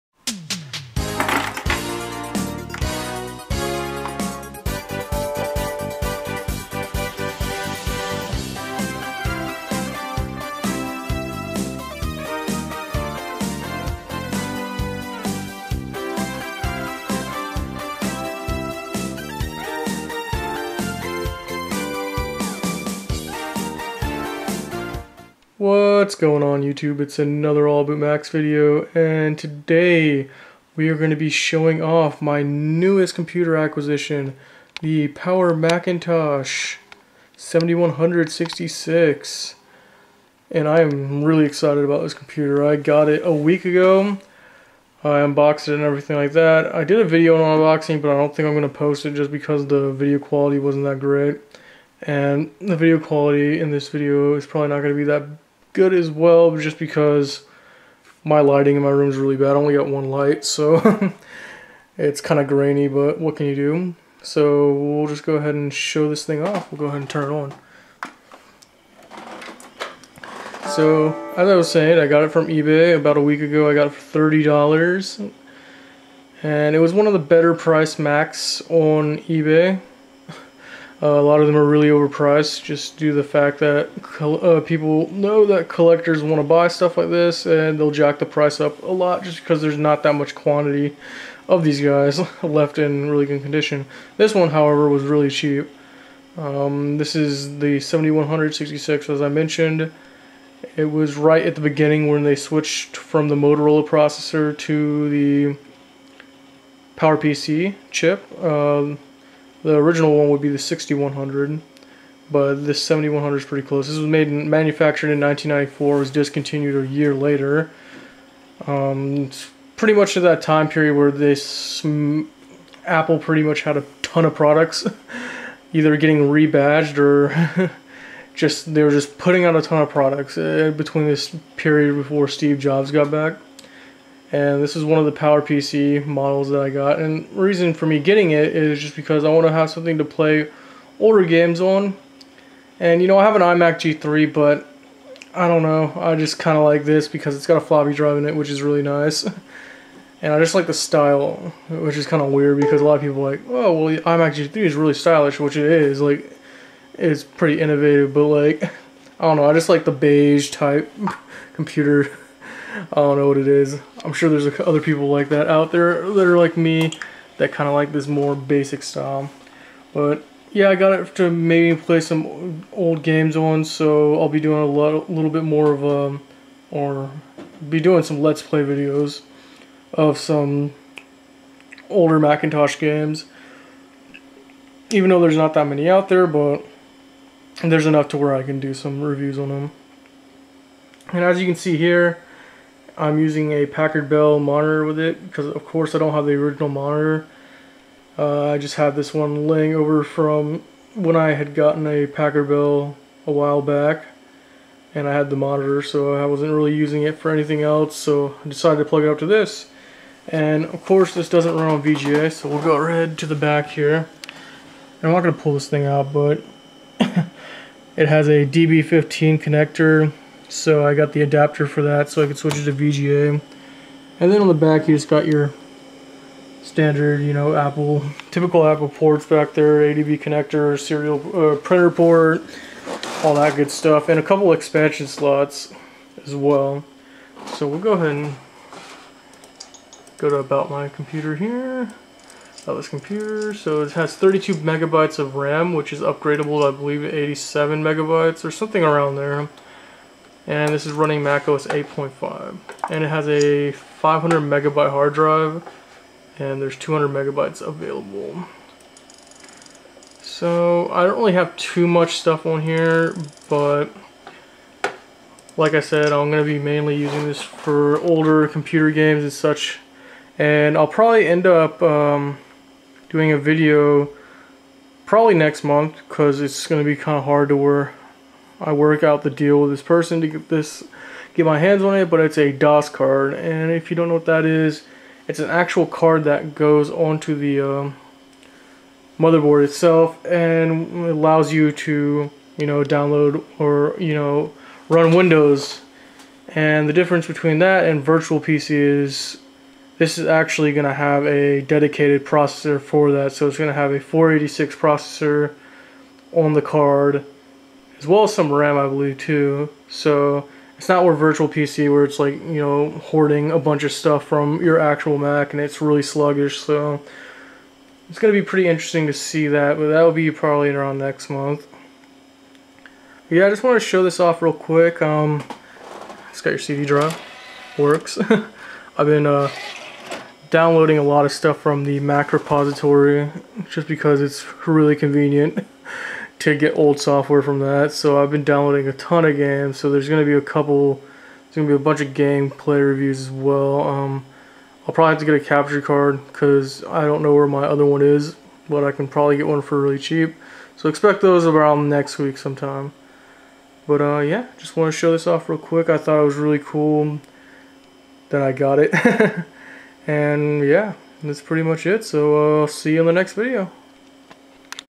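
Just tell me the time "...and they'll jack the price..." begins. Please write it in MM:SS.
01:27.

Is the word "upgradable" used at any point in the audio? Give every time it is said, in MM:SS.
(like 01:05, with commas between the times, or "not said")
04:06.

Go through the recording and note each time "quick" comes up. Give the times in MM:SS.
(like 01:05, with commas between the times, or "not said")
05:24, 05:55.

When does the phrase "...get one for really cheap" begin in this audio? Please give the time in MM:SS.
05:49.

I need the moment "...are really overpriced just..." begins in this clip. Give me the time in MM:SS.
01:21.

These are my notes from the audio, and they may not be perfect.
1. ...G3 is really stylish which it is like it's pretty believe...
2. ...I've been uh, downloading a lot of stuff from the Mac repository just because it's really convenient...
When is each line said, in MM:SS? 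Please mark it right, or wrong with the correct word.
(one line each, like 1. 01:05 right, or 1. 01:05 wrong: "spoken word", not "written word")
1. 02:34 wrong: "innovative", not "believe"
2. 05:28 right.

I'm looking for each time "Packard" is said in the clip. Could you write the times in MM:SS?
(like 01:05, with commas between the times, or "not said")
03:13, 03:22.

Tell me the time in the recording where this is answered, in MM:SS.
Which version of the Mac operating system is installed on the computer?
04:11.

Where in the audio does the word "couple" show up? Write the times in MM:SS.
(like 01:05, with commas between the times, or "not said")
03:54, 05:40.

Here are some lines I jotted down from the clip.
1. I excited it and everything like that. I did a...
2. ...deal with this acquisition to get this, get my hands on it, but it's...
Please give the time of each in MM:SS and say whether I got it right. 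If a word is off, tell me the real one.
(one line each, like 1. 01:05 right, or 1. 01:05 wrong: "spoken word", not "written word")
1. 00:45 wrong: "unboxed", not "excited"
2. 04:39 wrong: "person", not "acquisition".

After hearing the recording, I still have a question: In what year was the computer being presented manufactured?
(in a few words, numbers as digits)
1994.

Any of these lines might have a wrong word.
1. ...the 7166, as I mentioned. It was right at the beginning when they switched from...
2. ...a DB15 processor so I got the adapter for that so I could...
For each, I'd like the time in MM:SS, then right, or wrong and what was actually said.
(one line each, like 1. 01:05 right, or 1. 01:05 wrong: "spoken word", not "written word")
1. 01:37 right
2. 03:38 wrong: "connector", not "processor".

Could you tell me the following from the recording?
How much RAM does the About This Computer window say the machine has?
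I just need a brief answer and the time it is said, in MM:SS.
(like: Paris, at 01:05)
32 megabytes, at 04:04.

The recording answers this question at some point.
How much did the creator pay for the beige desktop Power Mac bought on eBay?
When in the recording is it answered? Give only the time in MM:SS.
01:14.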